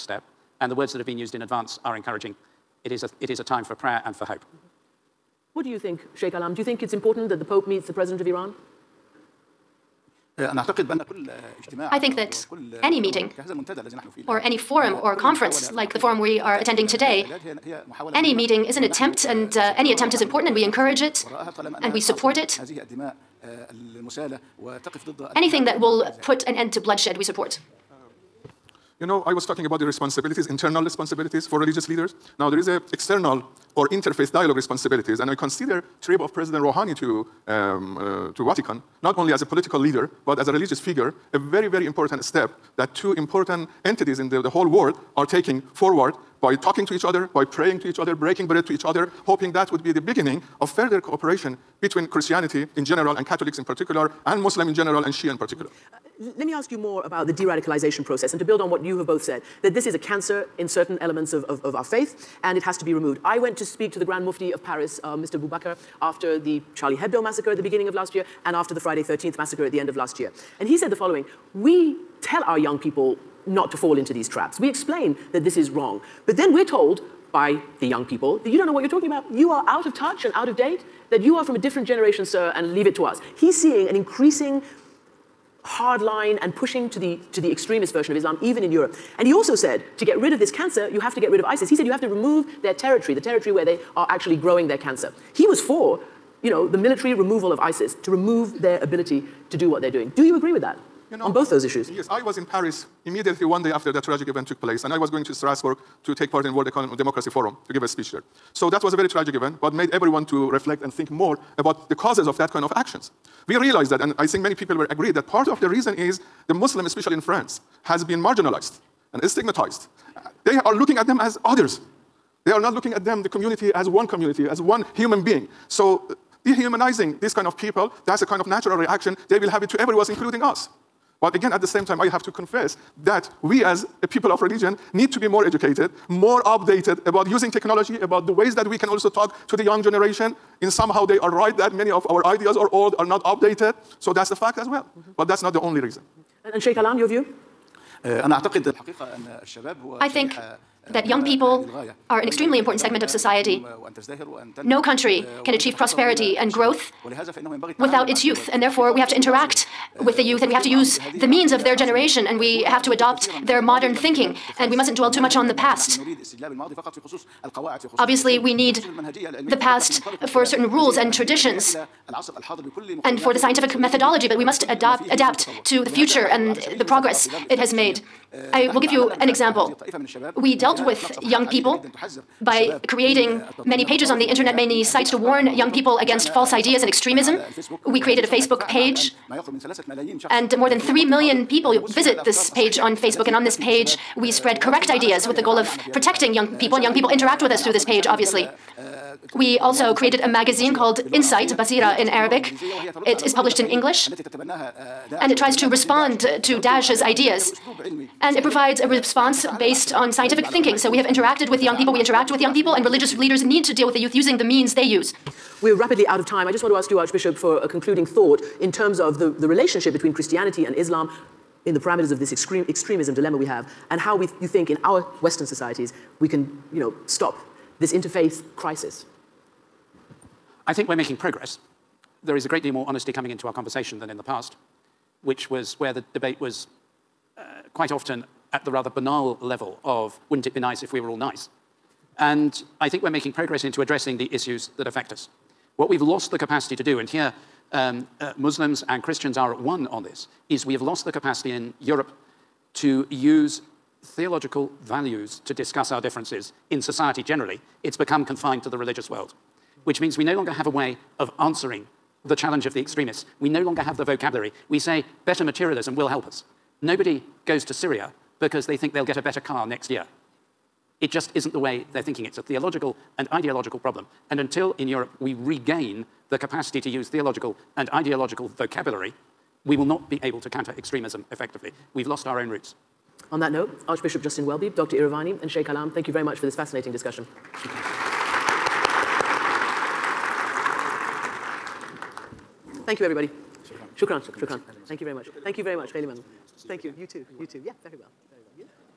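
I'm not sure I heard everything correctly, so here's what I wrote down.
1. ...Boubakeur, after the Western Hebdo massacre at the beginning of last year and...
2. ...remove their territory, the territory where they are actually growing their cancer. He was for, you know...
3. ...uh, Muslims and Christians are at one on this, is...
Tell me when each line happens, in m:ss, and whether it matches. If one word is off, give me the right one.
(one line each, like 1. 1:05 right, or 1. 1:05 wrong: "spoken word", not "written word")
1. 1:05 wrong: "Charlie", not "Western"
2. 1:32 right
3. 4:08 right.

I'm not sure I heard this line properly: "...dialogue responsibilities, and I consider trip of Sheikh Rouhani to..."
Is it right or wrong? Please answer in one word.
wrong.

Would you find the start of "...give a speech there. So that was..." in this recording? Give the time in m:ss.
1:47.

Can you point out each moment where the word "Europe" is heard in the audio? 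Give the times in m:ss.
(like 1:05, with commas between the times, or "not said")
1:28, 4:11, 4:34.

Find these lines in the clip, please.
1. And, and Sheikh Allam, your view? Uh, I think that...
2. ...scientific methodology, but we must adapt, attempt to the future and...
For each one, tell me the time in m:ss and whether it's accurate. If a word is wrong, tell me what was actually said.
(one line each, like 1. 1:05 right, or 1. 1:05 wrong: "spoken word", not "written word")
1. 2:26 right
2. 2:53 wrong: "adapt", not "attempt".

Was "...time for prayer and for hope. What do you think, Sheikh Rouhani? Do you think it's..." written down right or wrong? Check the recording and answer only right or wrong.
wrong.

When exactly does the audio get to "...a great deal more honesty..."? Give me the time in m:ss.
3:52.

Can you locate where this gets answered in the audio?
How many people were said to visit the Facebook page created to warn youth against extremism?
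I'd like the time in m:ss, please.
3:10.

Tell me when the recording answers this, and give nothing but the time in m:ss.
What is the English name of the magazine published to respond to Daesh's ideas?
3:21.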